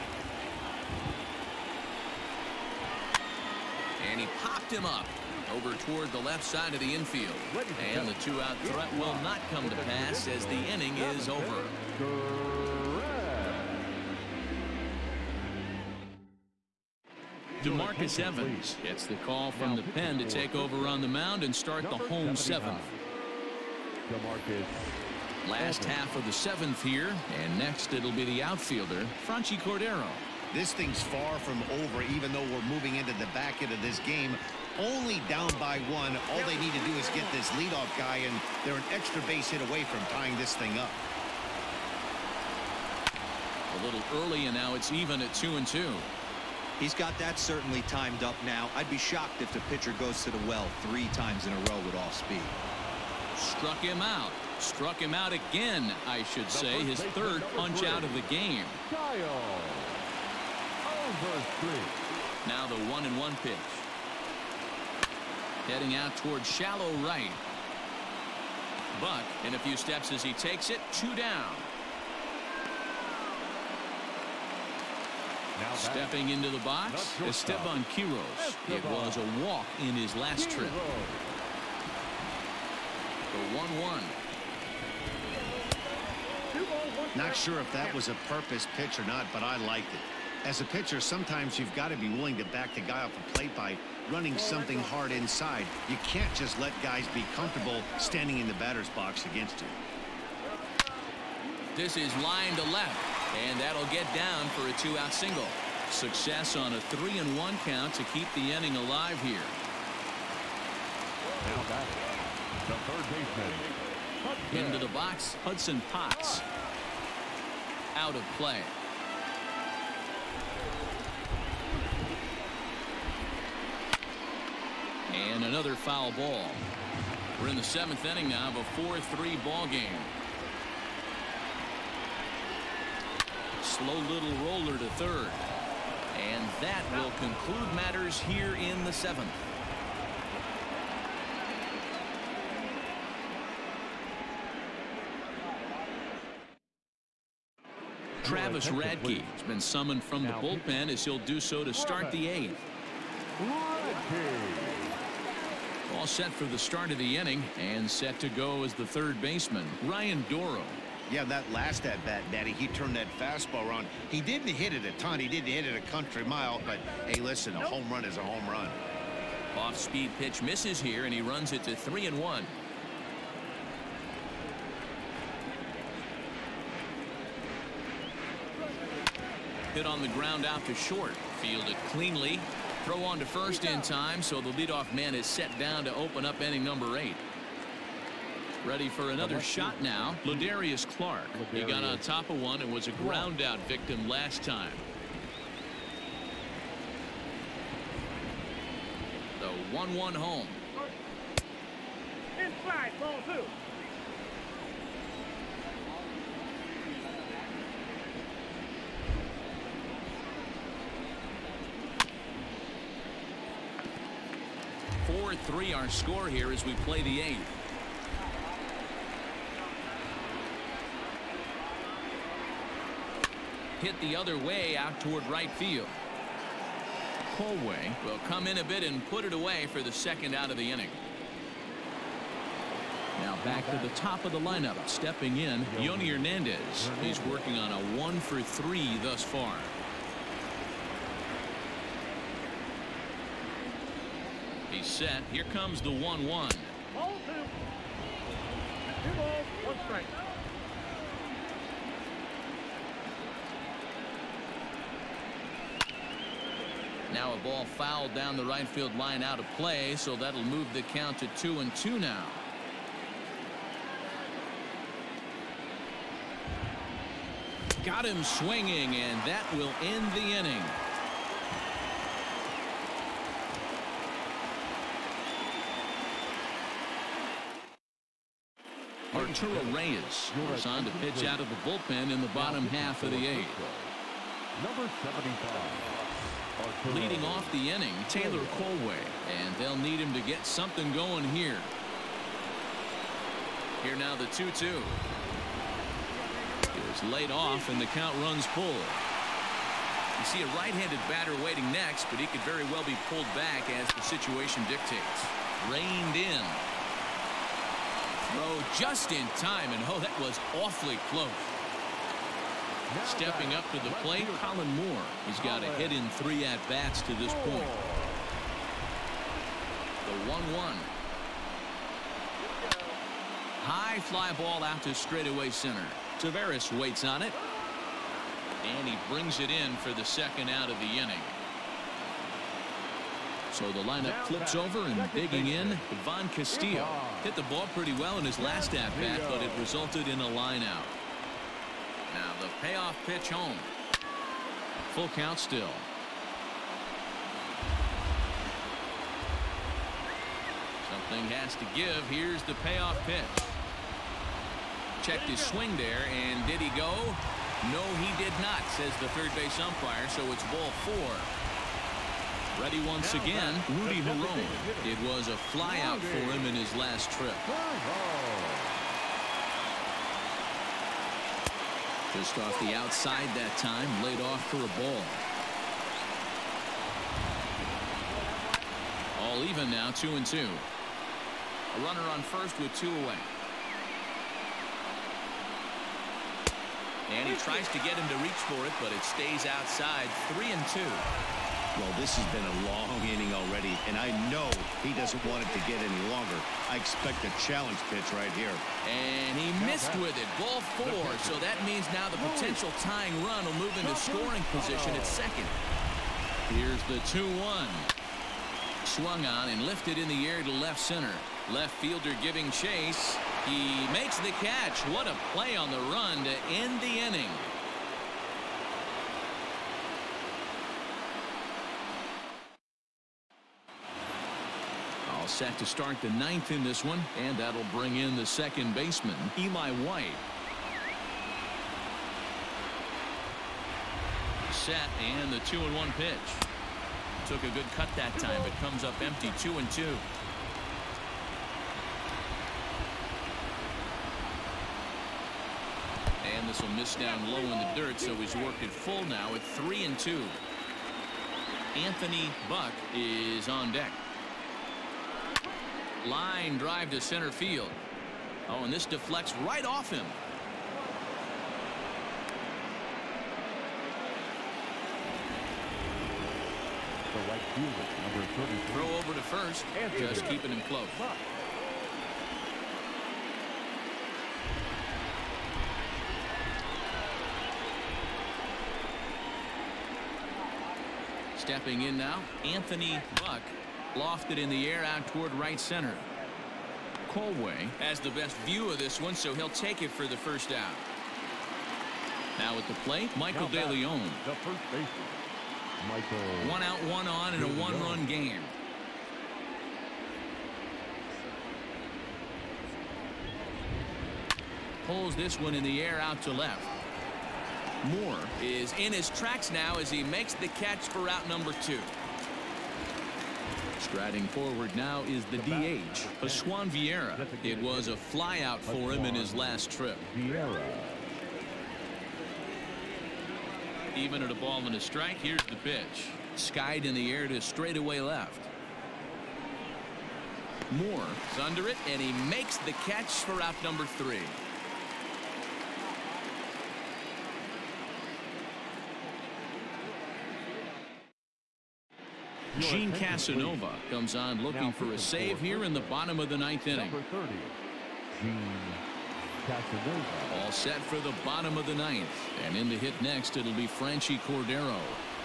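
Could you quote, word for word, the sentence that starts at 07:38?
Oh, and this deflects right off him.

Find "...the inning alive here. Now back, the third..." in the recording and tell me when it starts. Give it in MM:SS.
01:48.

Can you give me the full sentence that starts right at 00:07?
And the two-out threat will not come to pass as the inning is over.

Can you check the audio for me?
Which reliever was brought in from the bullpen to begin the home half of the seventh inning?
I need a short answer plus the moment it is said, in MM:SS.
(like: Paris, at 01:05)
DeMarcus Evans, at 00:17.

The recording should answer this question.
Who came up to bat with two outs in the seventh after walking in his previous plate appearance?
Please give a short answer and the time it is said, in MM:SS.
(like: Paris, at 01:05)
Esteban Quiroz, at 01:17.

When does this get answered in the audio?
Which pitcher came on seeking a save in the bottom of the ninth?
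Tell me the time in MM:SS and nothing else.
09:02.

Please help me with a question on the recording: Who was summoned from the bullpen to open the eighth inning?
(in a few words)
Travis Radke.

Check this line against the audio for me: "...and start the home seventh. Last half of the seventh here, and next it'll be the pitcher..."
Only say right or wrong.
wrong.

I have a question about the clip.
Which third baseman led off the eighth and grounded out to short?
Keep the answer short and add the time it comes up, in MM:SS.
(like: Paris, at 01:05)
Ryan Dorow, at 02:39.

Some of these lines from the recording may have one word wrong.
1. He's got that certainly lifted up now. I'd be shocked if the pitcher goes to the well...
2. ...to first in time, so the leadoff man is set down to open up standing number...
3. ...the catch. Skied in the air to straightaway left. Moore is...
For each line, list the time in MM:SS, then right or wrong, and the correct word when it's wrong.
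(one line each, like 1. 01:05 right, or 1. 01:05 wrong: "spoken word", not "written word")
1. 00:46 wrong: "timed", not "lifted"
2. 03:03 wrong: "inning", not "standing"
3. 08:45 wrong: "pitch", not "catch".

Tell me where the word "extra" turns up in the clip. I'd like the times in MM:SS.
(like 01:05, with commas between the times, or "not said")
00:38.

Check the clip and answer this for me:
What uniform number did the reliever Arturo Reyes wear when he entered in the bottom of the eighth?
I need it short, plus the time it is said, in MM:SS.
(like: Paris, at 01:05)
75, at 04:44.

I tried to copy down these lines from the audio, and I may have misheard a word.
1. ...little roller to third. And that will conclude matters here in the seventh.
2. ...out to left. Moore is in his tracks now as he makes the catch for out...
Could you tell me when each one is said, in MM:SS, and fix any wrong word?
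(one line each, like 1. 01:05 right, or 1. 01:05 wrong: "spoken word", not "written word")
1. 02:14 right
2. 08:26 right.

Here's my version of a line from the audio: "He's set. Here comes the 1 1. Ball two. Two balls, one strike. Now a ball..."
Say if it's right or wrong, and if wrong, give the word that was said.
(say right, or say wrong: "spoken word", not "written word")
right.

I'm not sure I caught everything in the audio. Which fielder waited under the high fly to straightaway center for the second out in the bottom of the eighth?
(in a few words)
Taveras.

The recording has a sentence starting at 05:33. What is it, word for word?
So the lineup flips over and digging in, Ivan Castillo.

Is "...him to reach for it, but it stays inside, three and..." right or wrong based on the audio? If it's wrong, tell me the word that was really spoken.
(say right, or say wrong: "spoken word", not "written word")
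wrong: "outside", not "inside".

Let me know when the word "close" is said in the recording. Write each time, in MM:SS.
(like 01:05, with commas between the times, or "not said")
05:11, 07:50.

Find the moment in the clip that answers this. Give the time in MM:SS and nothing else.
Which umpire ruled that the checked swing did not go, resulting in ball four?
05:59.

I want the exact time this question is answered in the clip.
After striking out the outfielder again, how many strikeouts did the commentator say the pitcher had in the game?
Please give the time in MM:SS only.
00:56.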